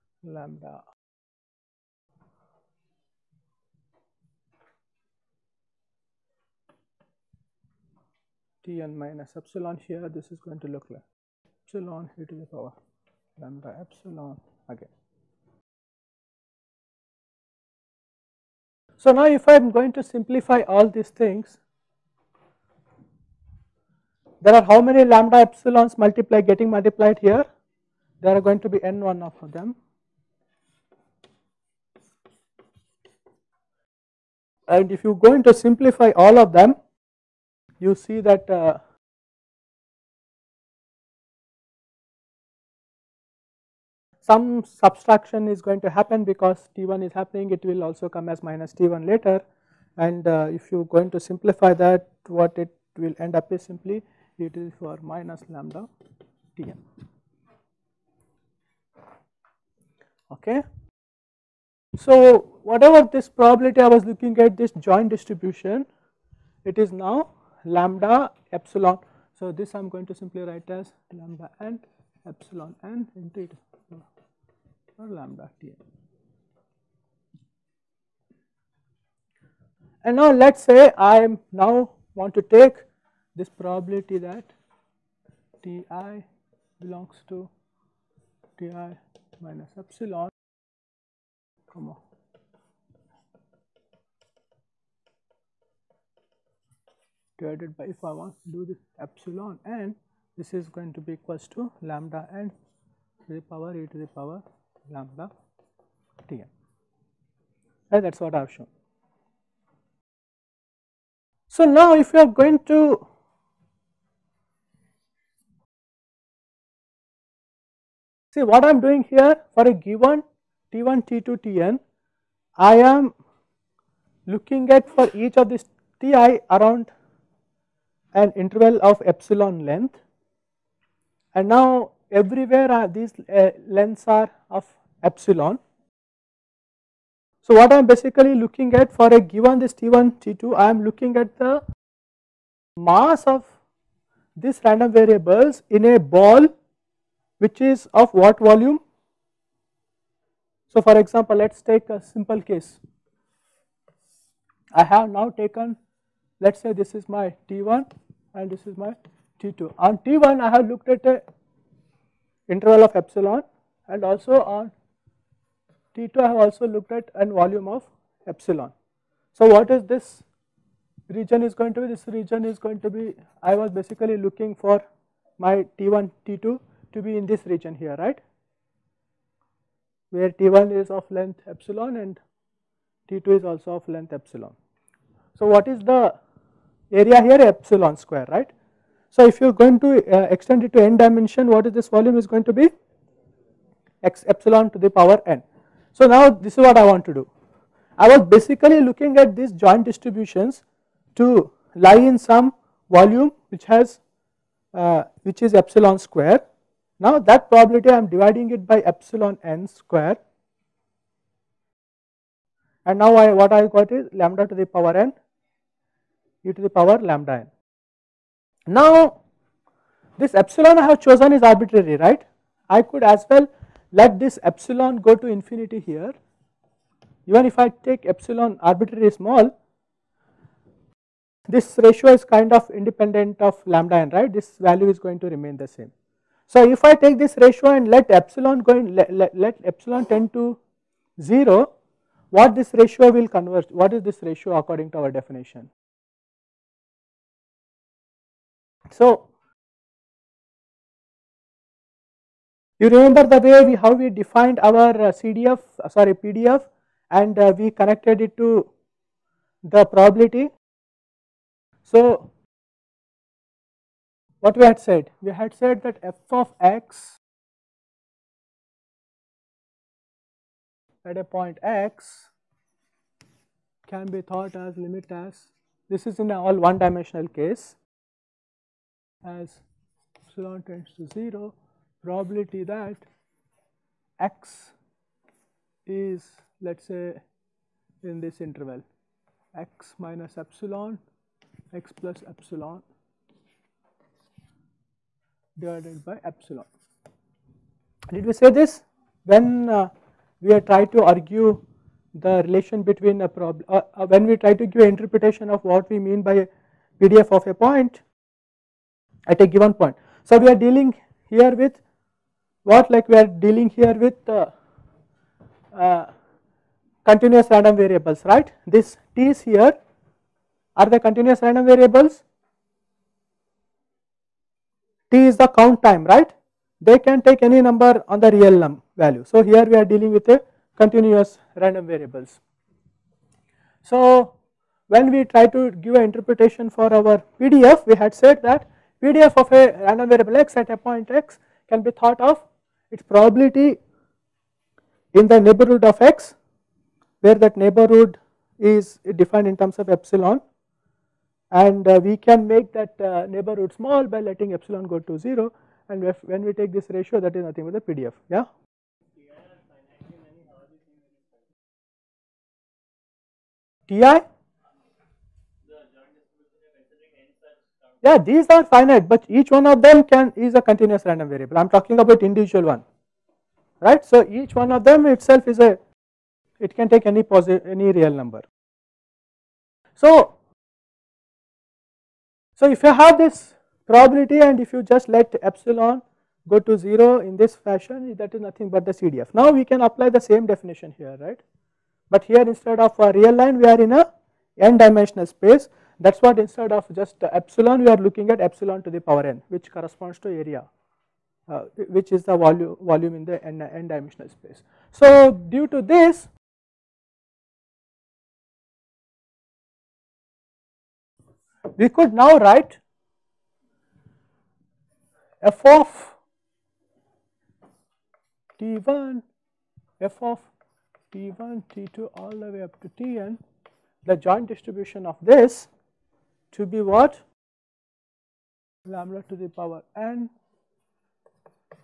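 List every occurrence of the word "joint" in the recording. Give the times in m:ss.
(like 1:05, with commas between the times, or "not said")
1:04, 3:19, 7:04.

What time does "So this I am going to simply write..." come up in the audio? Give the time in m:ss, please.
1:09.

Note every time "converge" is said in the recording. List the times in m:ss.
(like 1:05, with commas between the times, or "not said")
4:03.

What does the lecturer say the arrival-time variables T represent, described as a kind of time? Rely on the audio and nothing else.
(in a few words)
count time.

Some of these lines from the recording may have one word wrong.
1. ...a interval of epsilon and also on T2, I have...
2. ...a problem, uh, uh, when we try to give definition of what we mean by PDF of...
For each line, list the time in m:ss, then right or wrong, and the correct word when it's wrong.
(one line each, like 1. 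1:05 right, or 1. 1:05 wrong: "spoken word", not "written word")
1. 2:41 right
2. 5:03 wrong: "interpretation", not "definition".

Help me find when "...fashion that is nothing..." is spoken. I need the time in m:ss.
6:27.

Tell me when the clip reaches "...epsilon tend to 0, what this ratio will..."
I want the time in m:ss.
3:59.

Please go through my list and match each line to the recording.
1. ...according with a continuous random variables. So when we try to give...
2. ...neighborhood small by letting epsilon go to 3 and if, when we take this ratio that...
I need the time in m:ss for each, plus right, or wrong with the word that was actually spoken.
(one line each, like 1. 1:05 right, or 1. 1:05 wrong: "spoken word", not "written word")
1. 5:29 wrong: "dealing", not "according"
2. 5:53 wrong: "0", not "3".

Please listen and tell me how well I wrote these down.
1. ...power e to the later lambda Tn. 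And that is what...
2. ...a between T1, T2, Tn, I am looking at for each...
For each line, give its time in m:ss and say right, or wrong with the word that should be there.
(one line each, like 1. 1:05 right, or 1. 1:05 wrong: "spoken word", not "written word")
1. 1:43 wrong: "power", not "later"
2. 1:59 wrong: "given", not "between".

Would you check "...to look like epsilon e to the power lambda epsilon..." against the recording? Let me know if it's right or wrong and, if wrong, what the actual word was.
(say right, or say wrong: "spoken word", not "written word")
right.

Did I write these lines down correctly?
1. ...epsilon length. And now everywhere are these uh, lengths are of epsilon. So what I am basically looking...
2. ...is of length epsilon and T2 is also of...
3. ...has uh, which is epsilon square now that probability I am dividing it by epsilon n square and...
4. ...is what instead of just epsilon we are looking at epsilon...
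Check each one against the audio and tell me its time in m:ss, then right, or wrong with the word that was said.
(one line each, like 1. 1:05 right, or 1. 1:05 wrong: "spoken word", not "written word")
1. 2:09 right
2. 3:00 right
3. 3:23 right
4. 6:36 right.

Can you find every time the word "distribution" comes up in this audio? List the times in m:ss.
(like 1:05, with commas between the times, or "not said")
1:05, 3:19, 7:04.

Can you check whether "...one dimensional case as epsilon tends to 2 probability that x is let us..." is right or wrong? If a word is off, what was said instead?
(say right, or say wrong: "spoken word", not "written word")
wrong: "0", not "2".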